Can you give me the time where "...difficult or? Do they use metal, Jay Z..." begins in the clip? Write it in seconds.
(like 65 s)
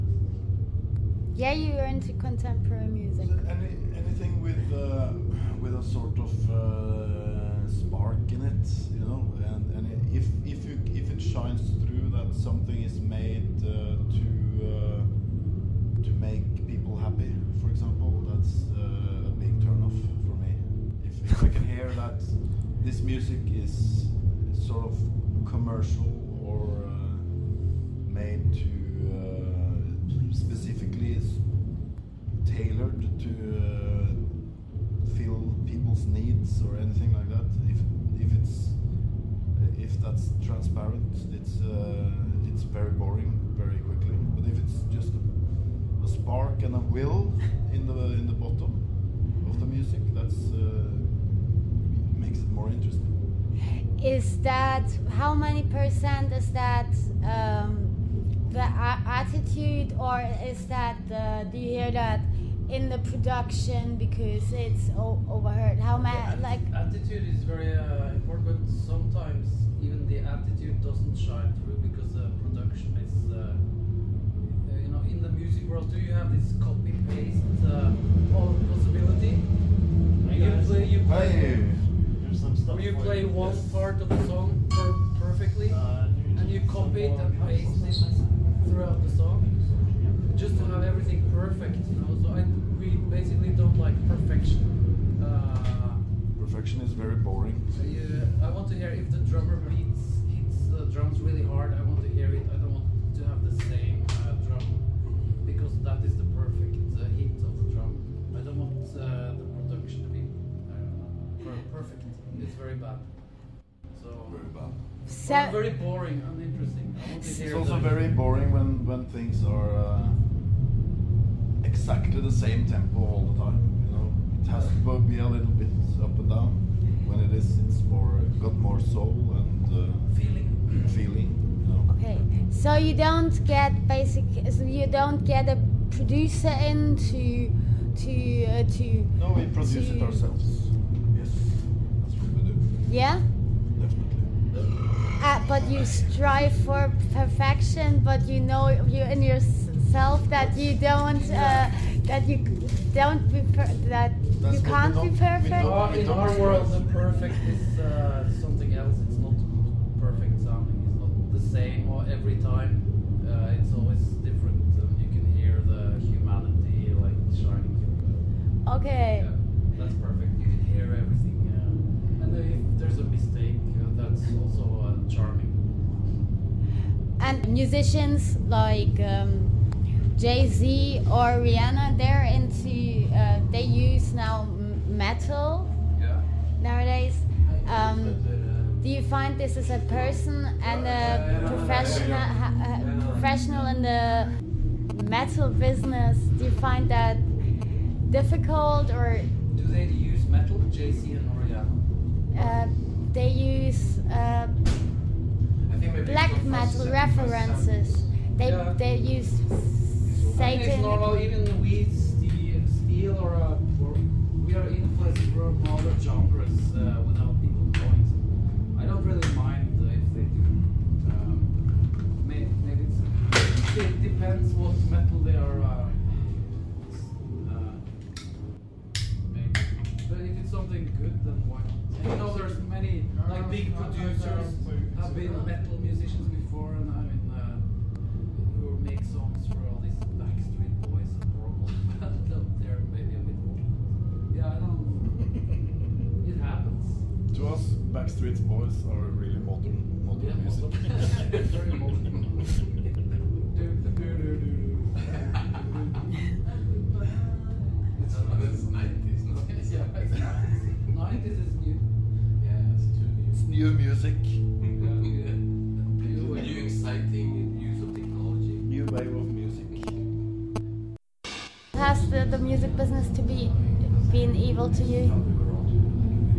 198 s.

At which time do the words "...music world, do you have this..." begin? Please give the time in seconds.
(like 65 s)
75 s.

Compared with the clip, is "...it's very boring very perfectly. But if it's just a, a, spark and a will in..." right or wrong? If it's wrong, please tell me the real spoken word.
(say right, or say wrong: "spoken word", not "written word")
wrong: "quickly", not "perfectly".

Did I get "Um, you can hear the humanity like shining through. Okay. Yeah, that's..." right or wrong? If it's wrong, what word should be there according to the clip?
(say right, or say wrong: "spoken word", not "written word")
right.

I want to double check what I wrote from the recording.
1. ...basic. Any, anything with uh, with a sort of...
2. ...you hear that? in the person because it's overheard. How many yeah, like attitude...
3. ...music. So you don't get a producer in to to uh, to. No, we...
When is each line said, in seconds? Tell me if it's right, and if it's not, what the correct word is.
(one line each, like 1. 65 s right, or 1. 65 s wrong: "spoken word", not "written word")
1. 2 s wrong: "music", not "basic"
2. 61 s wrong: "production", not "person"
3. 133 s wrong: "basic", not "music".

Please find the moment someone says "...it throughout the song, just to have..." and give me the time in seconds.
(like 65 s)
88 s.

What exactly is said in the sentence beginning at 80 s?
You play, you play, There's some stuff you play one yes.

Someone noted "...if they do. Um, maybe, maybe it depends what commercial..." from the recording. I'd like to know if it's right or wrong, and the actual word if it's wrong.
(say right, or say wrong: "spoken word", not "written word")
wrong: "metal", not "commercial".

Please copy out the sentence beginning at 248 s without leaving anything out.
Street Boys are really modern, modern yeah, music.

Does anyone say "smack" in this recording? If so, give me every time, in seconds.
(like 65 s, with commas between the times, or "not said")
not said.